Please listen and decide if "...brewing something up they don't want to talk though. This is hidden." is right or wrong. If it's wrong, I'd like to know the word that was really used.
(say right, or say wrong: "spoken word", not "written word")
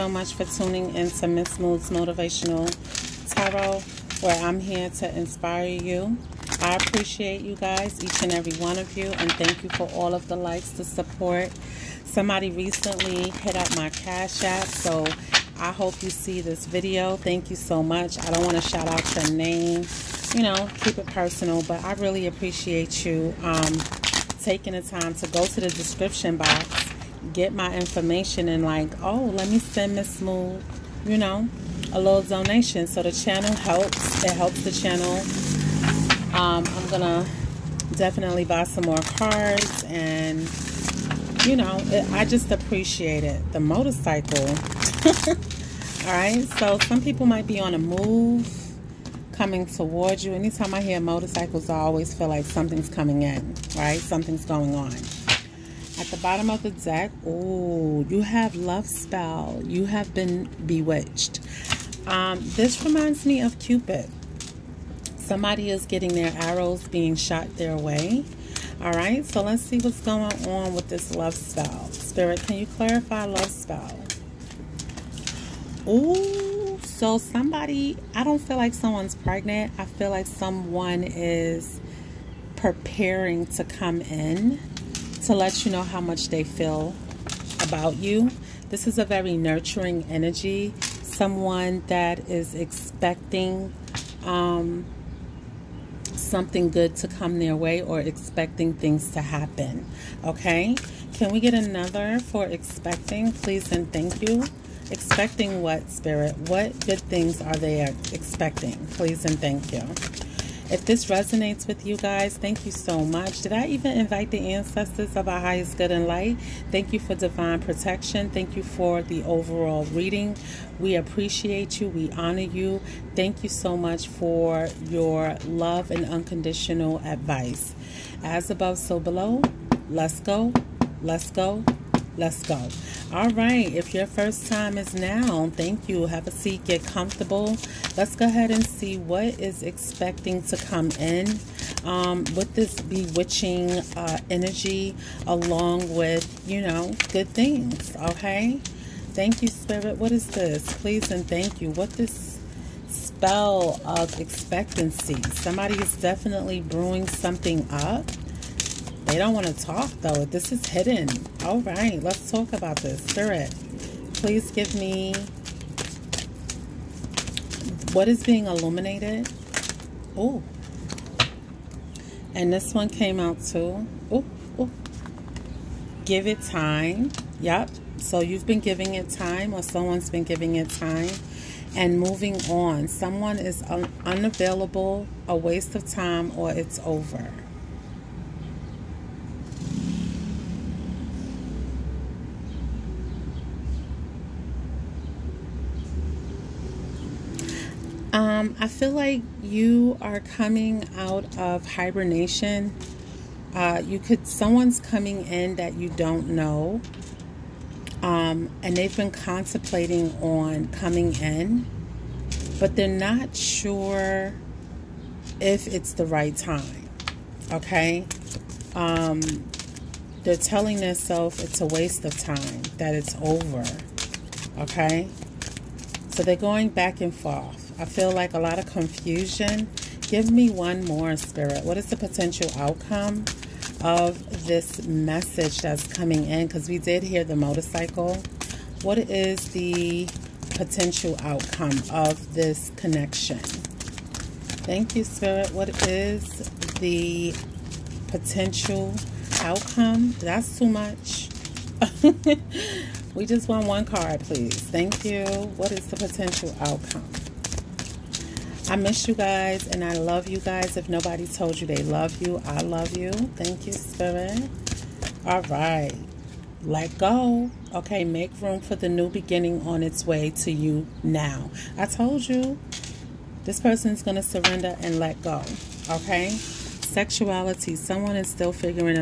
right.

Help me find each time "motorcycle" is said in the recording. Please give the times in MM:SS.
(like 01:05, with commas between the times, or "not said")
00:43, 00:50, 03:57.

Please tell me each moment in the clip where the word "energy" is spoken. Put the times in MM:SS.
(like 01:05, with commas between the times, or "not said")
01:30, 02:24.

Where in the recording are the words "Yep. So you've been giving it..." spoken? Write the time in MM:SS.
02:57.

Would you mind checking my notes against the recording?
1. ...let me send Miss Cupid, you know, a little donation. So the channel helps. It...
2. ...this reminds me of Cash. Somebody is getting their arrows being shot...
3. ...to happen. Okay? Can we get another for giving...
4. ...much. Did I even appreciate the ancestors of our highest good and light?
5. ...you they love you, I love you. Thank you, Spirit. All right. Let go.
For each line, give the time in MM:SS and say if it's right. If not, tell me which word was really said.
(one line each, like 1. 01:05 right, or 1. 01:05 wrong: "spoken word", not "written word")
1. 00:29 wrong: "Mood", not "Cupid"
2. 01:02 wrong: "Cupid", not "Cash"
3. 01:39 wrong: "expecting", not "giving"
4. 01:52 wrong: "invite", not "appreciate"
5. 04:21 right.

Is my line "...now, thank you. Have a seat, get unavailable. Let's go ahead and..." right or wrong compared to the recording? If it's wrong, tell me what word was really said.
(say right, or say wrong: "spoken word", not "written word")
wrong: "comfortable", not "unavailable".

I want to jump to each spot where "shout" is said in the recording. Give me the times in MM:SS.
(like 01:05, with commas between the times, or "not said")
00:18.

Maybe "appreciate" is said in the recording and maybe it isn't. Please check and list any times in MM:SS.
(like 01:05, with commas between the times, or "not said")
00:06, 00:22, 00:42, 02:00.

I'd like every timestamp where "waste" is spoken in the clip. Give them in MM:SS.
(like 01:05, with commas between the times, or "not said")
03:05, 03:41.